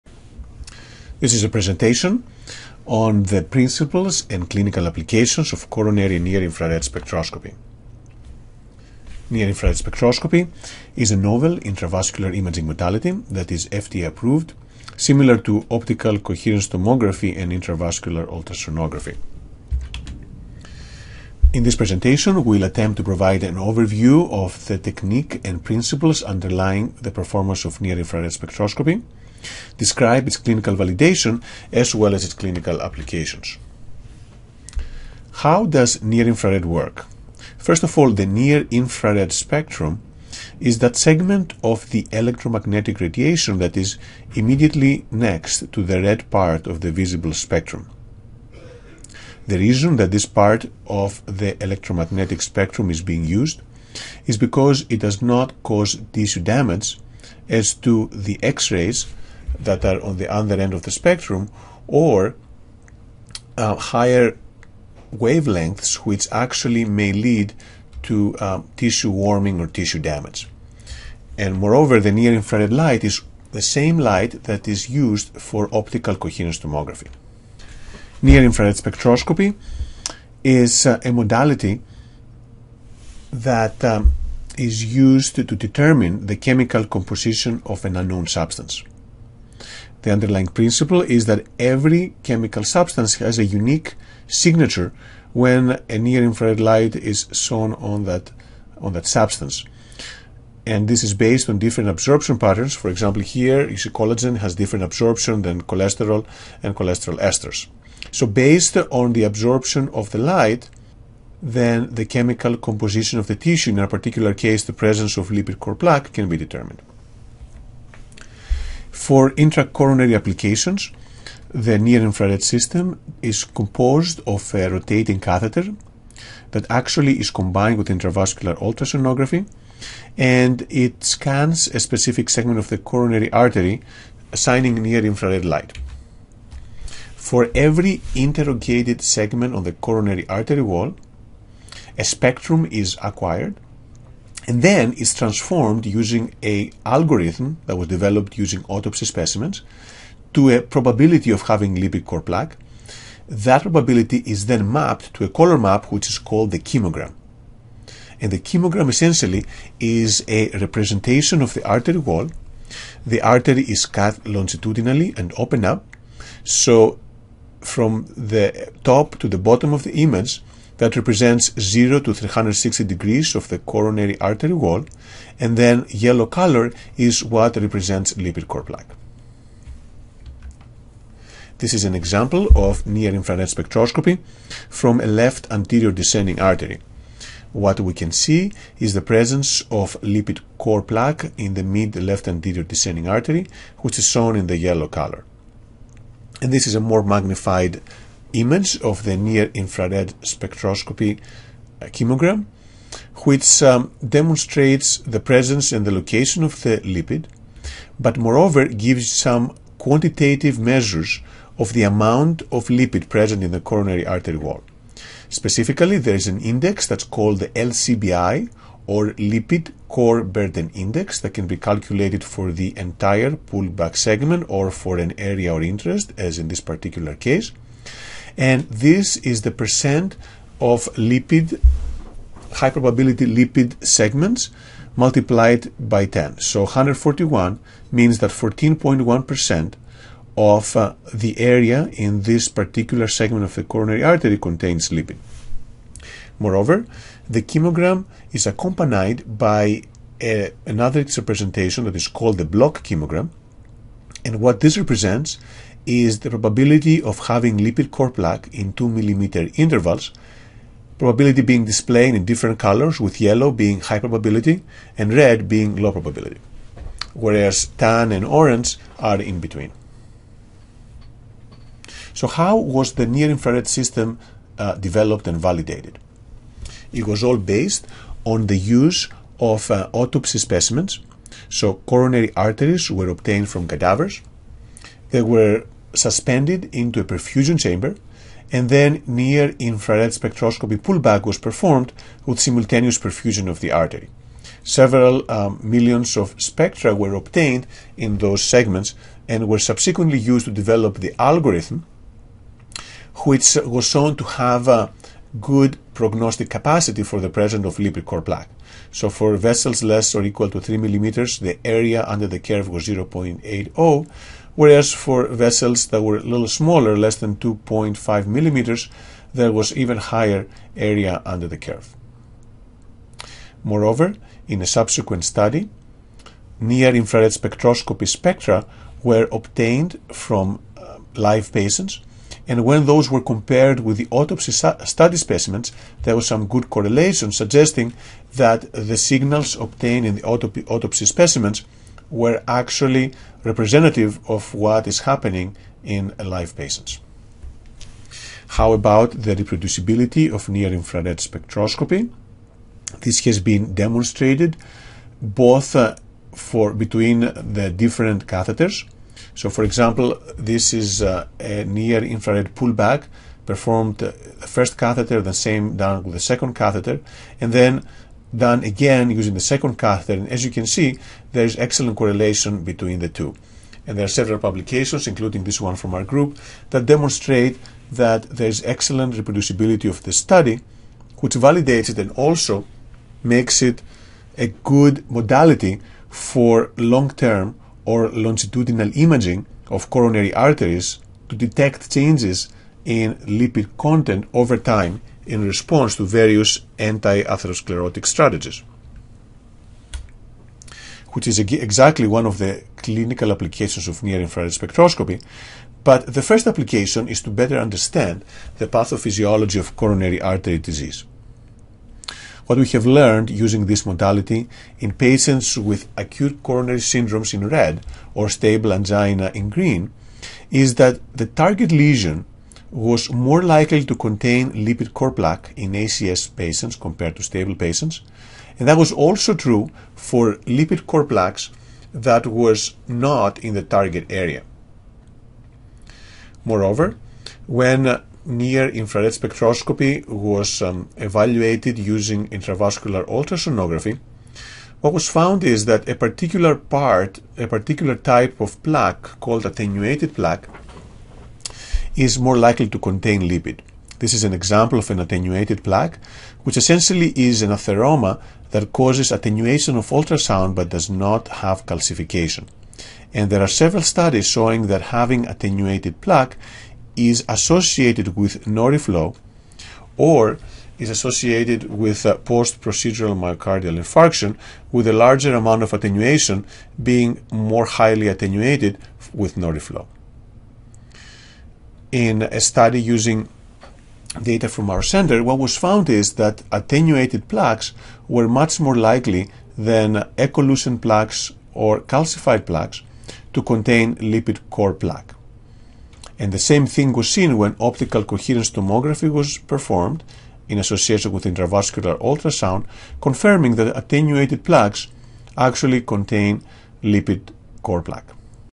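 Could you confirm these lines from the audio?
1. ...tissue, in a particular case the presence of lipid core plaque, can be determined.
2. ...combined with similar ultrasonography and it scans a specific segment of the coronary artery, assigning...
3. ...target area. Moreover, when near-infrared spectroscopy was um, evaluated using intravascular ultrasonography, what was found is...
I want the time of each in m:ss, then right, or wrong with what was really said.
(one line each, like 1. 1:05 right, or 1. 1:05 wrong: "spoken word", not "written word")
1. 1:53 right
2. 2:07 wrong: "intravascular", not "similar"
3. 7:13 right.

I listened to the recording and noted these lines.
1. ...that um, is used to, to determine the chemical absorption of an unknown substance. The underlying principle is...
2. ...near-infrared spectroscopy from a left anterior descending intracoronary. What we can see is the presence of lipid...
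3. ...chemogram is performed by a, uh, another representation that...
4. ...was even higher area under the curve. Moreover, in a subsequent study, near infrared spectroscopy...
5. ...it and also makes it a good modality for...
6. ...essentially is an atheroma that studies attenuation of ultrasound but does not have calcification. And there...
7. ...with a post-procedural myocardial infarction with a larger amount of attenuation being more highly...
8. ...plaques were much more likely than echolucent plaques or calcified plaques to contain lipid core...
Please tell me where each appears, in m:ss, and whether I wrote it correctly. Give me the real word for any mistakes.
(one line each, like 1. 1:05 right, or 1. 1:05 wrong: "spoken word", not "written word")
1. 1:23 wrong: "composition", not "absorption"
2. 3:02 wrong: "artery", not "intracoronary"
3. 4:07 wrong: "accompanied", not "performed"
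4. 5:19 right
5. 6:21 right
6. 7:36 wrong: "causes", not "studies"
7. 7:51 right
8. 8:07 right.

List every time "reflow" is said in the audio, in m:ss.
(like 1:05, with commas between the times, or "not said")
7:48, 7:59.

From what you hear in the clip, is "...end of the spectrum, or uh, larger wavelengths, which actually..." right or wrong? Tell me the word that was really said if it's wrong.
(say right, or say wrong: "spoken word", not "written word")
wrong: "higher", not "larger".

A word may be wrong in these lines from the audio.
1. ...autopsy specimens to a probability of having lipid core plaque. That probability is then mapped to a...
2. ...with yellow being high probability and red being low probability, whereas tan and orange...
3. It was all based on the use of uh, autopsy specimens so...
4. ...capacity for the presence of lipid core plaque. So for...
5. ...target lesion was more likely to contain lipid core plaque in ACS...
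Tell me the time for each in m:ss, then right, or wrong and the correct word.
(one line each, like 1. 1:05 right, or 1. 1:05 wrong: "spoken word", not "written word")
1. 2:28 right
2. 4:22 right
3. 4:36 right
4. 5:06 right
5. 7:01 right.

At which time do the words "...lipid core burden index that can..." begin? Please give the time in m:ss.
3:39.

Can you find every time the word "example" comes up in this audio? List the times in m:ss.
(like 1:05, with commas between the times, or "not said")
1:42, 3:01, 5:59, 7:34.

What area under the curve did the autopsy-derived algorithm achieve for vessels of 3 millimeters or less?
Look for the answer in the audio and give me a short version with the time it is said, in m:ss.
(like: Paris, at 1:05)
0.80, at 5:12.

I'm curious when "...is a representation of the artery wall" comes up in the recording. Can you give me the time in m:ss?
2:39.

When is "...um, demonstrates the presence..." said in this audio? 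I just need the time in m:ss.
3:23.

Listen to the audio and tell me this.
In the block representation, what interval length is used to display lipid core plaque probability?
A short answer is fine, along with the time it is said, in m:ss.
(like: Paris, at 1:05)
2 millimeters, at 4:18.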